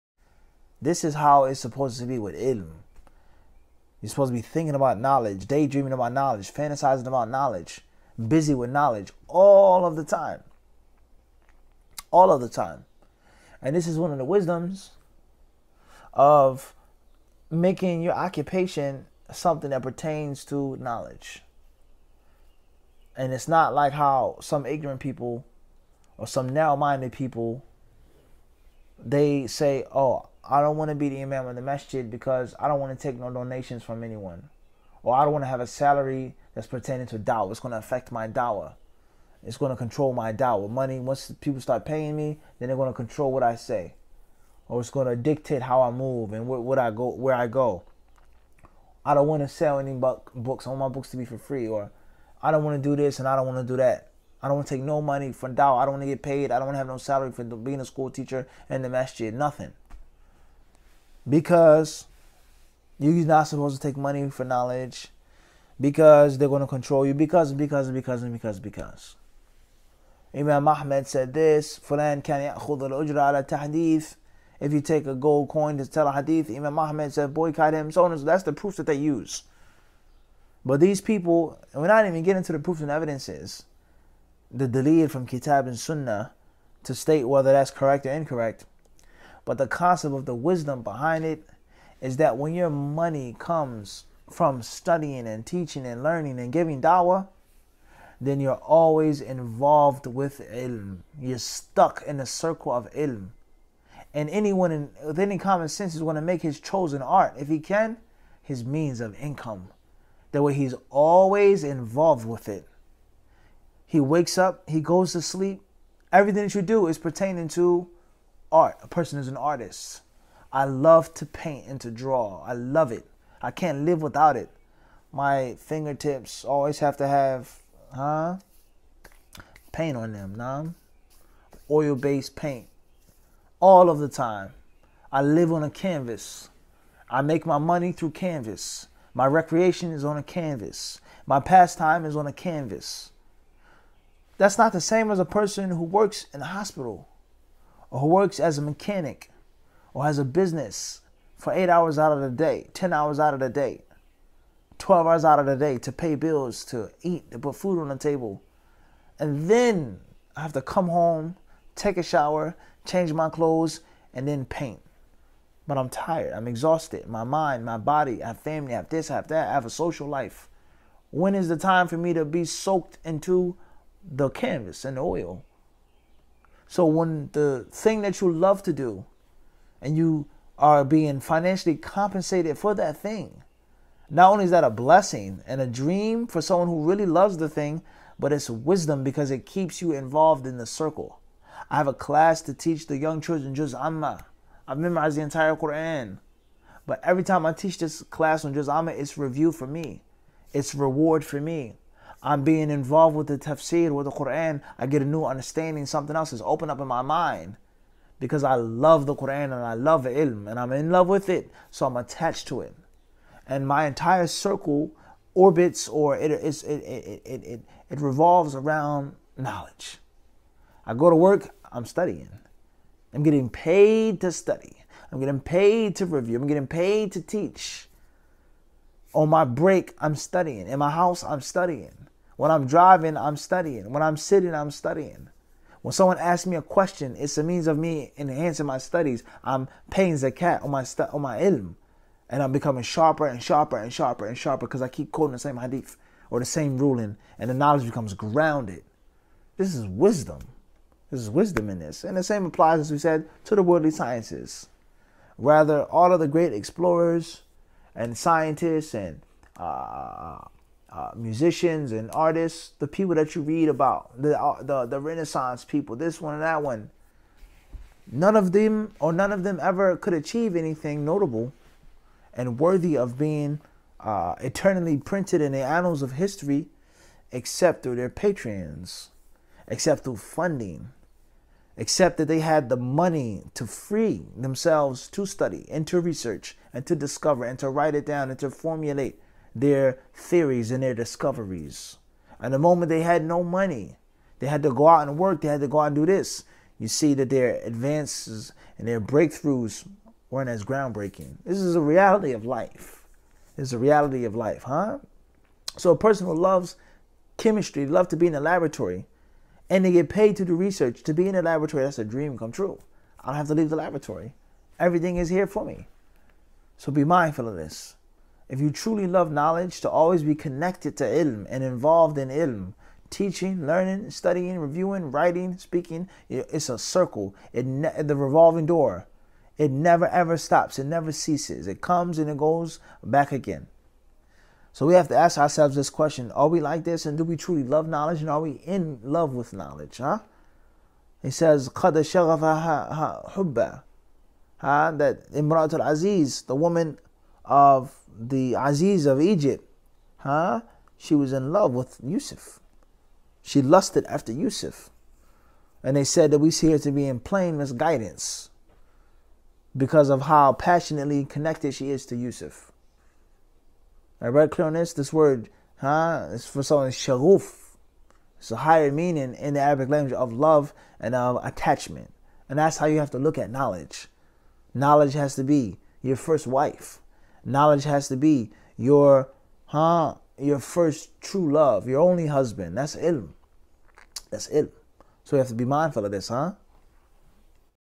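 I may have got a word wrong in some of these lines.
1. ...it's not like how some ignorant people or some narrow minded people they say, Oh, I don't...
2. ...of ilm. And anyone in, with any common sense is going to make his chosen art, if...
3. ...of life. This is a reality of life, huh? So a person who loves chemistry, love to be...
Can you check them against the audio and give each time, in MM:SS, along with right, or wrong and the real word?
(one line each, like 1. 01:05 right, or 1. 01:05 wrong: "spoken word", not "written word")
1. 00:23 right
2. 01:42 right
3. 05:02 right.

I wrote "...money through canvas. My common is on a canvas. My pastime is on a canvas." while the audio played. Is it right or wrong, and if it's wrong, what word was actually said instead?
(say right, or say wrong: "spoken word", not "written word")
wrong: "recreation", not "common".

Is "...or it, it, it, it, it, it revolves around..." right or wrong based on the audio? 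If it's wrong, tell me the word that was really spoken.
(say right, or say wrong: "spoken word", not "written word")
right.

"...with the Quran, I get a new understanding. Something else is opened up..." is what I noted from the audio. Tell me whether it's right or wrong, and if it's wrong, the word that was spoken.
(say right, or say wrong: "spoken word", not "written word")
right.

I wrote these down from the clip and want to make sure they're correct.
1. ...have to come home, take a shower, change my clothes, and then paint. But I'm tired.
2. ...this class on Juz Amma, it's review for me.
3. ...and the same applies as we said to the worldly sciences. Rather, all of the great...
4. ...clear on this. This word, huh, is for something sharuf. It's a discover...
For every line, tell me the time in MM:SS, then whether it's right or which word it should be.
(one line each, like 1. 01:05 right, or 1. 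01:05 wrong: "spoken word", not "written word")
1. 02:40 right
2. 03:17 right
3. 04:12 right
4. 06:04 wrong: "higher", not "discover".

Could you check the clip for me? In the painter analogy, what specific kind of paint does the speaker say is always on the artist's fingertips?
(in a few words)
Oil based paint.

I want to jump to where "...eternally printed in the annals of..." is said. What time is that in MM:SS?
04:34.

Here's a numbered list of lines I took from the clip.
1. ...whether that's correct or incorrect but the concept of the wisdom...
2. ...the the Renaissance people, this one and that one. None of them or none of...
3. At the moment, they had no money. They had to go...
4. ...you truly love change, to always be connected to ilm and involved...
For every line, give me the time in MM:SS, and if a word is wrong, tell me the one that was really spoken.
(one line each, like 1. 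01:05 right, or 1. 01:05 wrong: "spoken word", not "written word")
1. 01:27 right
2. 04:24 right
3. 04:52 right
4. 05:18 wrong: "knowledge", not "change".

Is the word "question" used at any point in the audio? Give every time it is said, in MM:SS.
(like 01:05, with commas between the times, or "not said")
03:56, 05:35.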